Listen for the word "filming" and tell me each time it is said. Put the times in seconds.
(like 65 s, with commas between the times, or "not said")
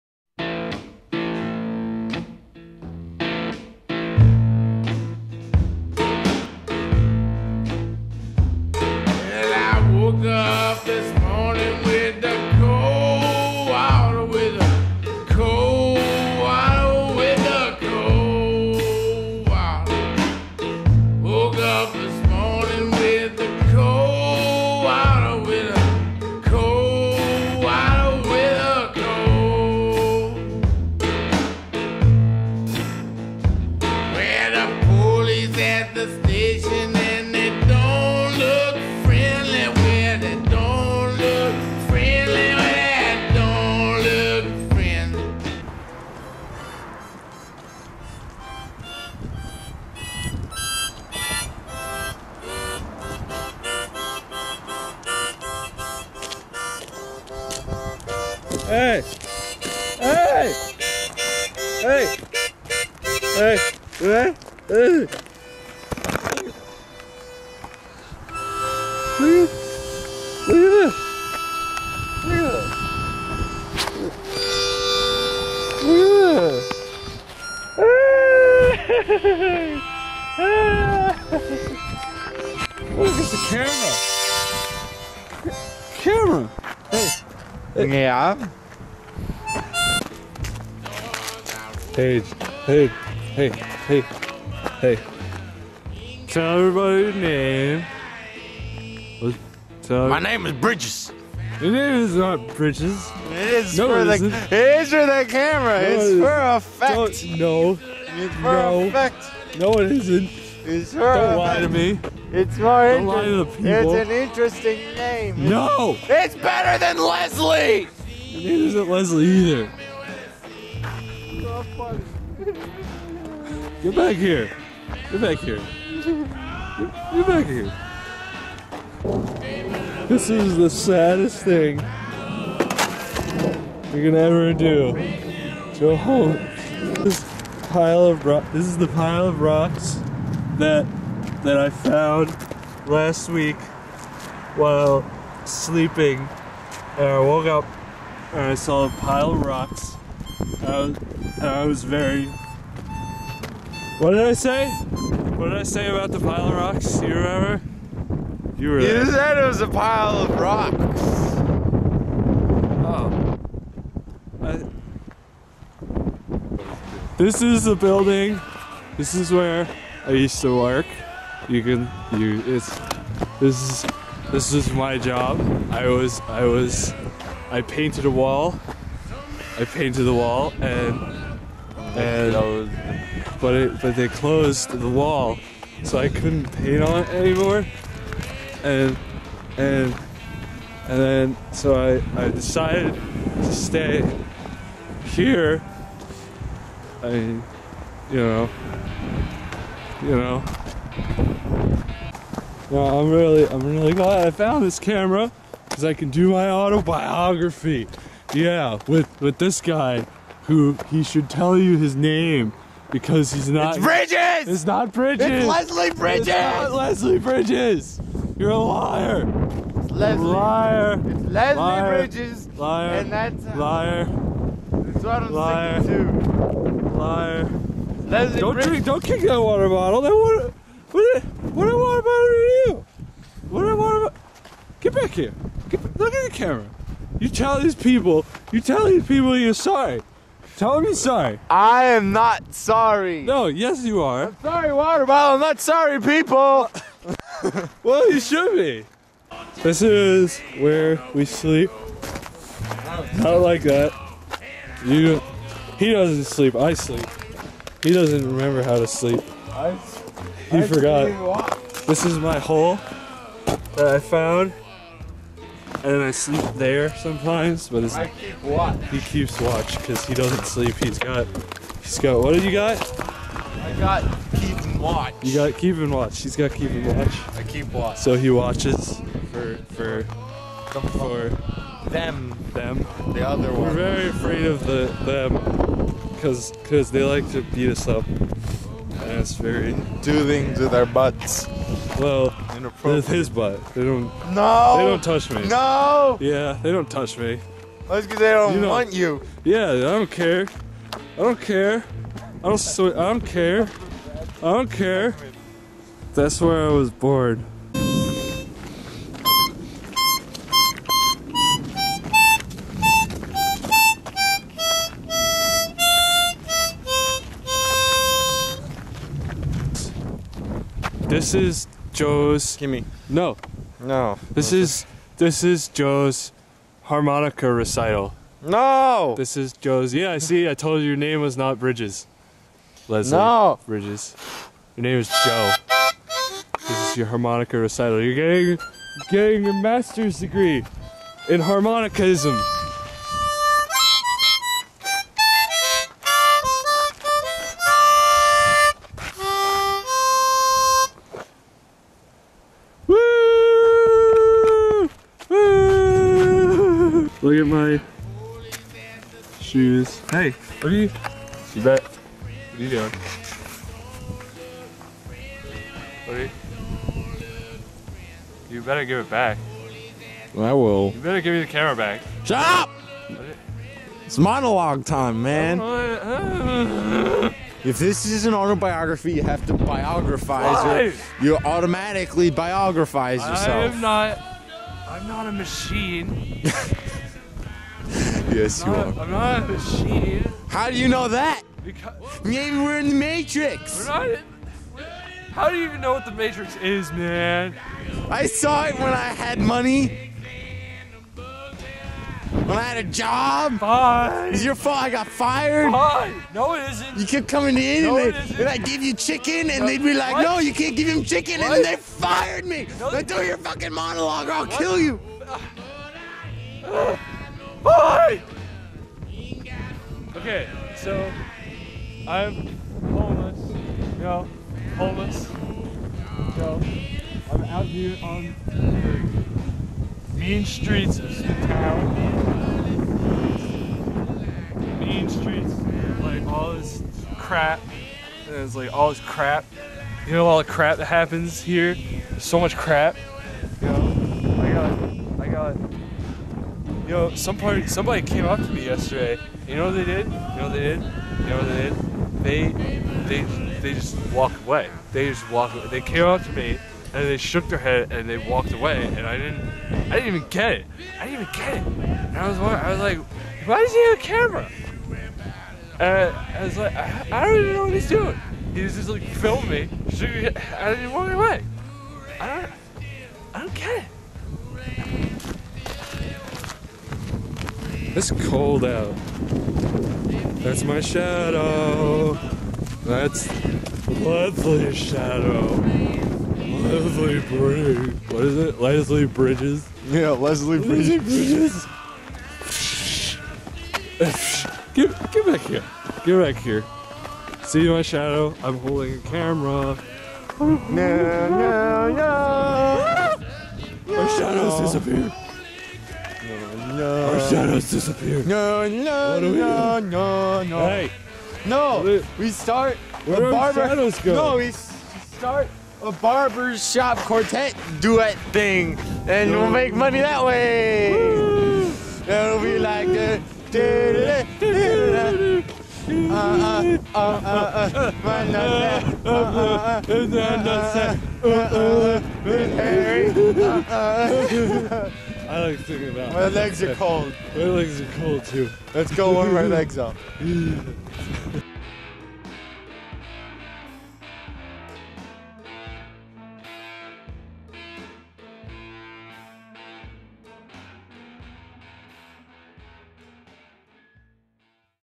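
469 s.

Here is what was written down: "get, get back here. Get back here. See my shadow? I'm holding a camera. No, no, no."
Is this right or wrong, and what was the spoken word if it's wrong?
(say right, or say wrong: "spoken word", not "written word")
right.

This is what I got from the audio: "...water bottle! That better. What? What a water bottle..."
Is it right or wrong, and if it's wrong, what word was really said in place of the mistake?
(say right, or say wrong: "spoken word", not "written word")
wrong: "water", not "better".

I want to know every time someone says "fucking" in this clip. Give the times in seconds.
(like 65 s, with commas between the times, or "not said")
413 s.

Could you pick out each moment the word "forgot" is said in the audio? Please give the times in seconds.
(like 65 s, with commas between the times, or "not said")
260 s.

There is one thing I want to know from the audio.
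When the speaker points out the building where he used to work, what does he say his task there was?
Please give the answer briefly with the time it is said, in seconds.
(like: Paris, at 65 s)
Painted a wall, at 177 s.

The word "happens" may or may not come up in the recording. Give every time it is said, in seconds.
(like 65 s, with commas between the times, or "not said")
440 s.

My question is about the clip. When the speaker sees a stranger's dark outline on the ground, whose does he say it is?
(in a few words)
Leslie's shadow.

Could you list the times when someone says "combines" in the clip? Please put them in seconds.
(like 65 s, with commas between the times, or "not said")
not said.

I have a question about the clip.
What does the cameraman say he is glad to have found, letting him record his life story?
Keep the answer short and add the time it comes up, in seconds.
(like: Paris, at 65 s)
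This camera, at 204 s.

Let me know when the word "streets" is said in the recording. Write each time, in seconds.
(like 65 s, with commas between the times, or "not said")
430 s, 435 s.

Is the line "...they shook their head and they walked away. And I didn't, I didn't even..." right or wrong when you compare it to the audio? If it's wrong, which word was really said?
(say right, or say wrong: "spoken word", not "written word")
right.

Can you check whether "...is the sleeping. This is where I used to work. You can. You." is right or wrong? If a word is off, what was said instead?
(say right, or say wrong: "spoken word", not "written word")
wrong: "building", not "sleeping".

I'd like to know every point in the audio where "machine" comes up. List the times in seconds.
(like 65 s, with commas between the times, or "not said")
385 s, 389 s.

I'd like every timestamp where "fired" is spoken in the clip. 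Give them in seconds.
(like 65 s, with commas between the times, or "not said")
405 s, 411 s.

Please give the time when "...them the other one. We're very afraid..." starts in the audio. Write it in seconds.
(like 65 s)
282 s.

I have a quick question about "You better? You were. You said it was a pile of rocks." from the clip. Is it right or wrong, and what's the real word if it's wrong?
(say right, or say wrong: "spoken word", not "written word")
wrong: "remember", not "better".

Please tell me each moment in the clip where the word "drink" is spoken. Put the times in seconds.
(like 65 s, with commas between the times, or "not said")
228 s.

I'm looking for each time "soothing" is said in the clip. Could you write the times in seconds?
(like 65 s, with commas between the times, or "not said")
not said.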